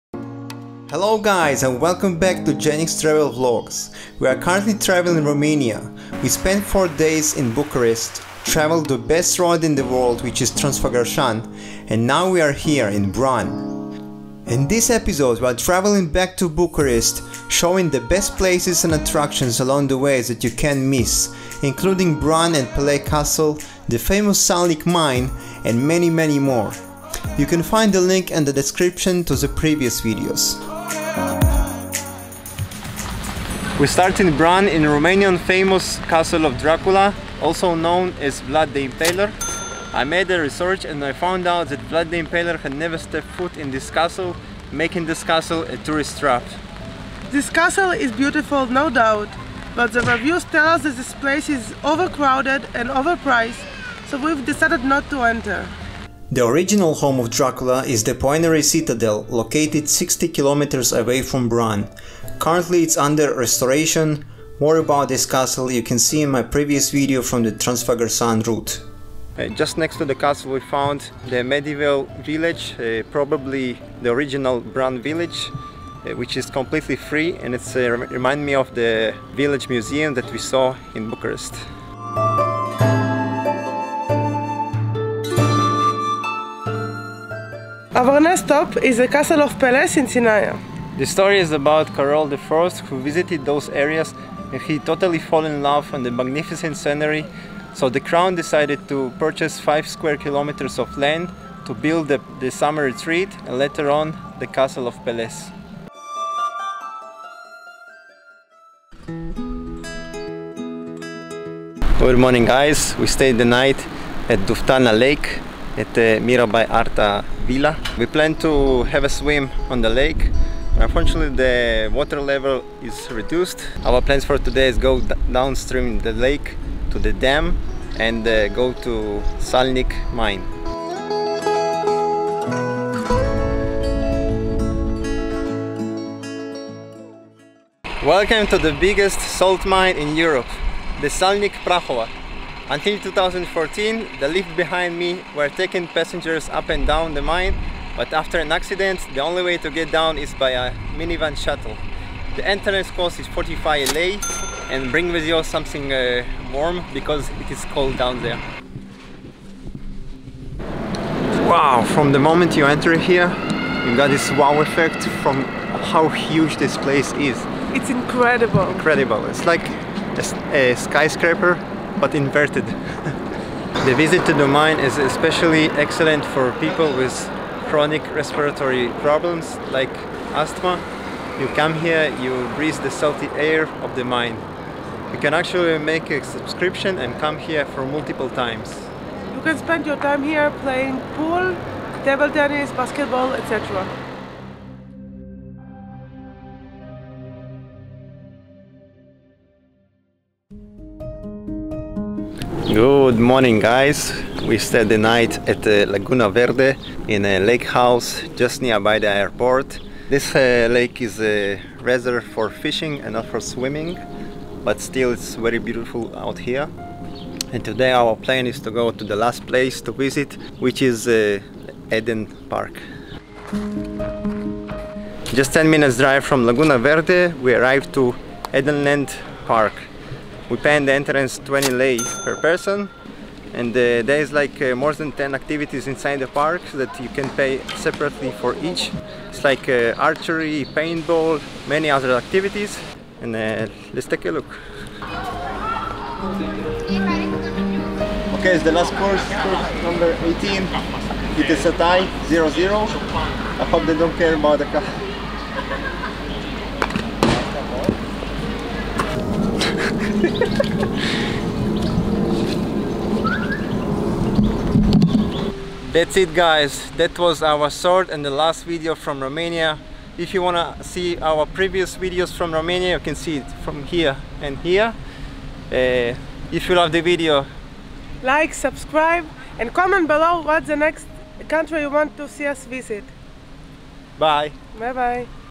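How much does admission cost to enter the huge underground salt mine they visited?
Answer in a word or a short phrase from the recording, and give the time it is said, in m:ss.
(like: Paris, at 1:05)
45 lei, at 2:33.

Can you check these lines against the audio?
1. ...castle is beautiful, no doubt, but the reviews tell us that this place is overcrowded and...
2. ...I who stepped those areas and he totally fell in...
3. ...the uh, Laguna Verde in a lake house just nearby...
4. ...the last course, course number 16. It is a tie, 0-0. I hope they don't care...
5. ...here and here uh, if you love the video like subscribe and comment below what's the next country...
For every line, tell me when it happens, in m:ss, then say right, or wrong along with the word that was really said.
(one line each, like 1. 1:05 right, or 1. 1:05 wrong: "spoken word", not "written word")
1. 0:47 right
2. 1:32 wrong: "visited", not "stepped"
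3. 3:25 right
4. 4:08 wrong: "18", not "16"
5. 4:33 right.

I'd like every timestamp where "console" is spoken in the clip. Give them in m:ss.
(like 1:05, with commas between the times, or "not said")
not said.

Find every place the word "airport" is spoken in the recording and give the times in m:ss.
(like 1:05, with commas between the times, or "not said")
3:29.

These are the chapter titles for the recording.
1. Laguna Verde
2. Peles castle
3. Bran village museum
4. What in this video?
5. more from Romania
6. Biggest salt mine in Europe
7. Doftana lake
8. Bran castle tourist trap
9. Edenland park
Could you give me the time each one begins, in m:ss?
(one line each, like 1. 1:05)
1. 3:20
2. 1:28
3. 1:09
4. 0:14
5. 4:25
6. 2:17
7. 1:52
8. 0:33
9. 3:45.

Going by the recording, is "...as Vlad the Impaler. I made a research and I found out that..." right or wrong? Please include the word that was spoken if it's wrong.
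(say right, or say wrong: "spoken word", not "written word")
right.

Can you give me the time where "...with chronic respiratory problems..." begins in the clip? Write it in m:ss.
2:56.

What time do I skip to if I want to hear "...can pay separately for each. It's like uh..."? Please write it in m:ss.
3:57.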